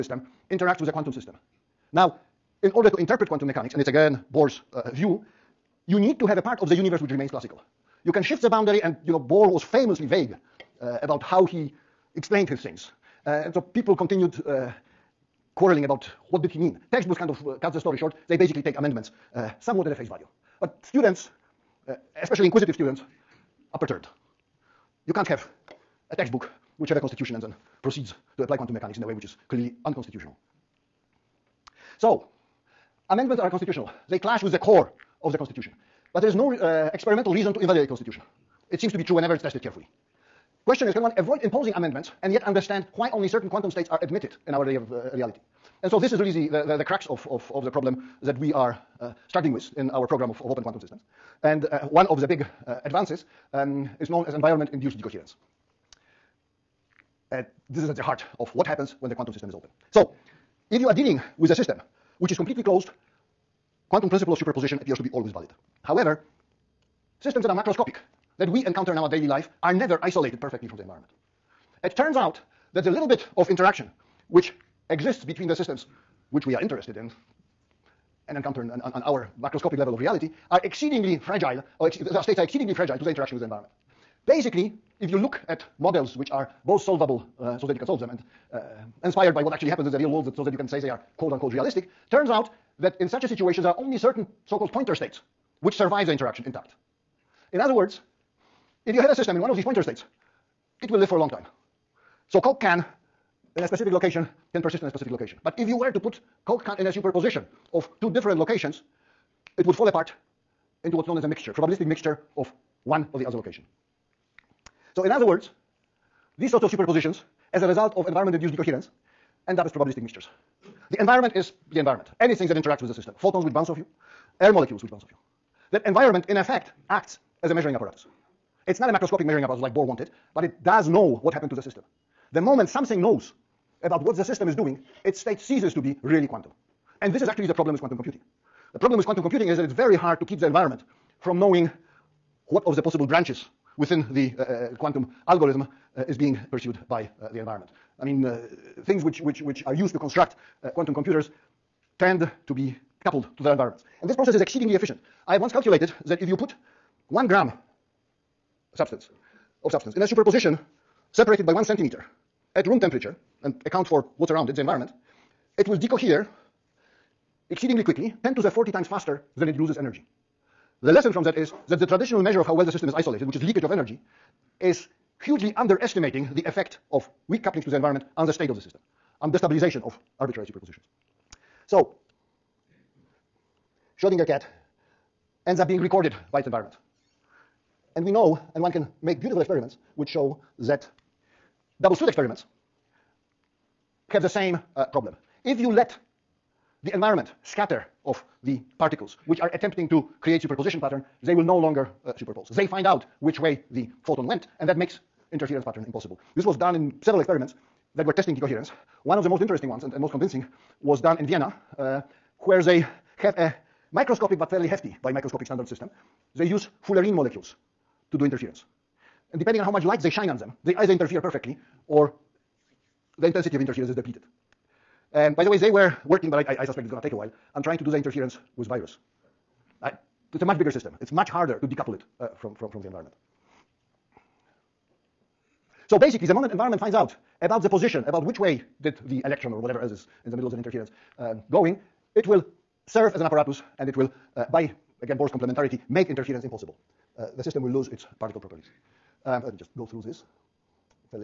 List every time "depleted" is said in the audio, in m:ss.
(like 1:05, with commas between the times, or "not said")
3:43.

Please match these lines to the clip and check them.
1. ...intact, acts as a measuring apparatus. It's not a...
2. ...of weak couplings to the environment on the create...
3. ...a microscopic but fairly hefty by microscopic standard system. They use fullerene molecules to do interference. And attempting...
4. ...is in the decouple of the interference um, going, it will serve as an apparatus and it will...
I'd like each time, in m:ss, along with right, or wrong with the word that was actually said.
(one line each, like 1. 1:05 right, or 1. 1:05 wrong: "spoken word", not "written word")
1. 2:06 wrong: "effect", not "intact"
2. 2:56 wrong: "state", not "create"
3. 3:33 wrong: "depending", not "attempting"
4. 3:59 wrong: "middle", not "decouple".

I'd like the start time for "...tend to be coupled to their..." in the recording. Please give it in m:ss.
2:31.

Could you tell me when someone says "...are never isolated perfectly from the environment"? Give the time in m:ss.
1:09.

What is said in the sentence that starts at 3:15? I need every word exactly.
If you let the environment scatter of the particles which are attempting to create superposition pattern, they will no longer uh, superpose.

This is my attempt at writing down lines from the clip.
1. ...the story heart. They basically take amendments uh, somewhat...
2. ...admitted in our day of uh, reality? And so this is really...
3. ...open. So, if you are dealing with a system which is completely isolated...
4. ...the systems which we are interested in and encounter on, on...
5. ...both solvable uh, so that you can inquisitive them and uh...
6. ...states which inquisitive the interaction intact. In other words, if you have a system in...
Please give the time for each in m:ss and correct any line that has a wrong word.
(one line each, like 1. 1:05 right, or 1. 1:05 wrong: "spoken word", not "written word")
1. 0:17 wrong: "short", not "heart"
2. 0:44 right
3. 0:59 wrong: "closed", not "isolated"
4. 1:15 right
5. 1:26 wrong: "solve", not "inquisitive"
6. 1:34 wrong: "survive", not "inquisitive".